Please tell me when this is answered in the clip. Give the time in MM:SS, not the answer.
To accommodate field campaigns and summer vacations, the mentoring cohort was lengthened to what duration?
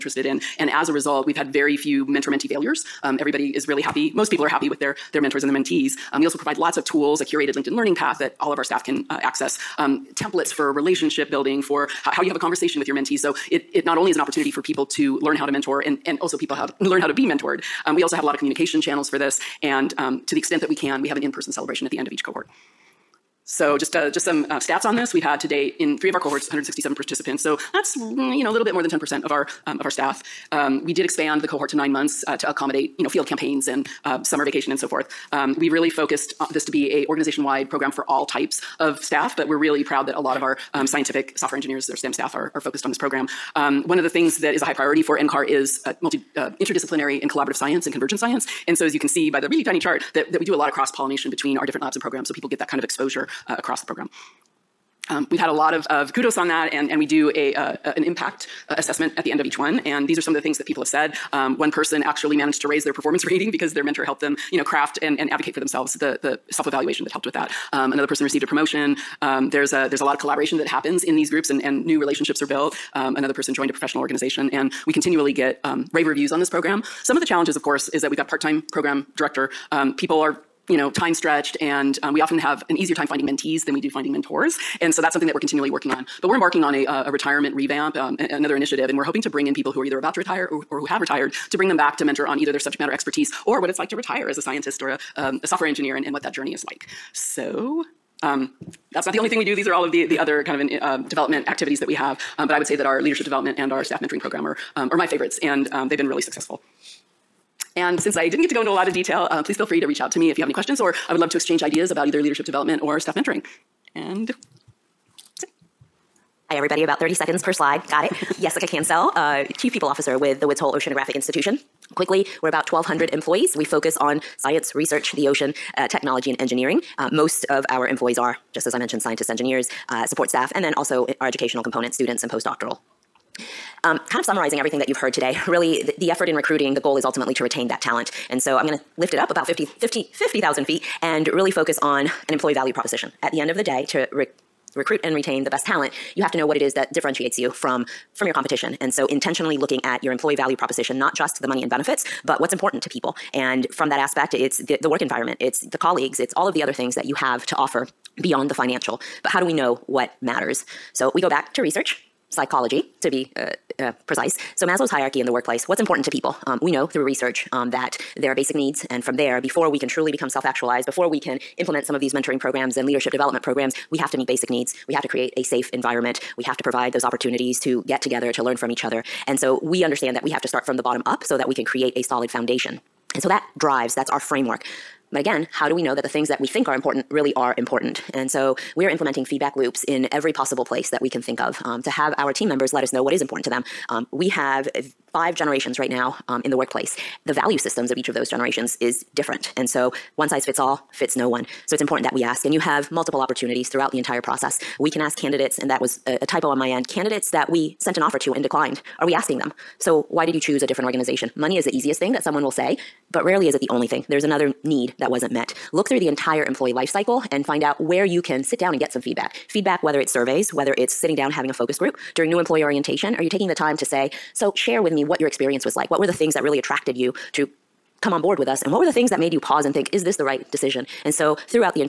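00:31.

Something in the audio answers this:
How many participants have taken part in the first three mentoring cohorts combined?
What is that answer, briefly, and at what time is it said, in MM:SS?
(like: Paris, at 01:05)
167, at 00:26.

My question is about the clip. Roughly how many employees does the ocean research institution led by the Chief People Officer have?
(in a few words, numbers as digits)
1,200.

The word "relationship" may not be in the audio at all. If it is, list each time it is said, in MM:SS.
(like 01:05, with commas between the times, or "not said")
00:10, 01:12.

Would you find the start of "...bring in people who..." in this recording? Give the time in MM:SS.
01:29.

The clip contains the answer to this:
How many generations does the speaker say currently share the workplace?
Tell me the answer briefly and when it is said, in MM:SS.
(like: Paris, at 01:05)
5, at 03:15.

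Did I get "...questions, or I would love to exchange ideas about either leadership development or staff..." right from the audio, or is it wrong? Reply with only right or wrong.
right.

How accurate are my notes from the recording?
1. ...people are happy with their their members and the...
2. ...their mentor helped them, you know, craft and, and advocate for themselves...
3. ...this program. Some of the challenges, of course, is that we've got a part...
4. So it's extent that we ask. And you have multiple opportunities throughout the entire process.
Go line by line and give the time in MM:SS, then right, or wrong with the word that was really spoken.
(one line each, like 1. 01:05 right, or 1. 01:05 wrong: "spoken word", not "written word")
1. 00:04 wrong: "mentors", not "members"
2. 01:03 right
3. 01:16 right
4. 03:21 wrong: "important", not "extent".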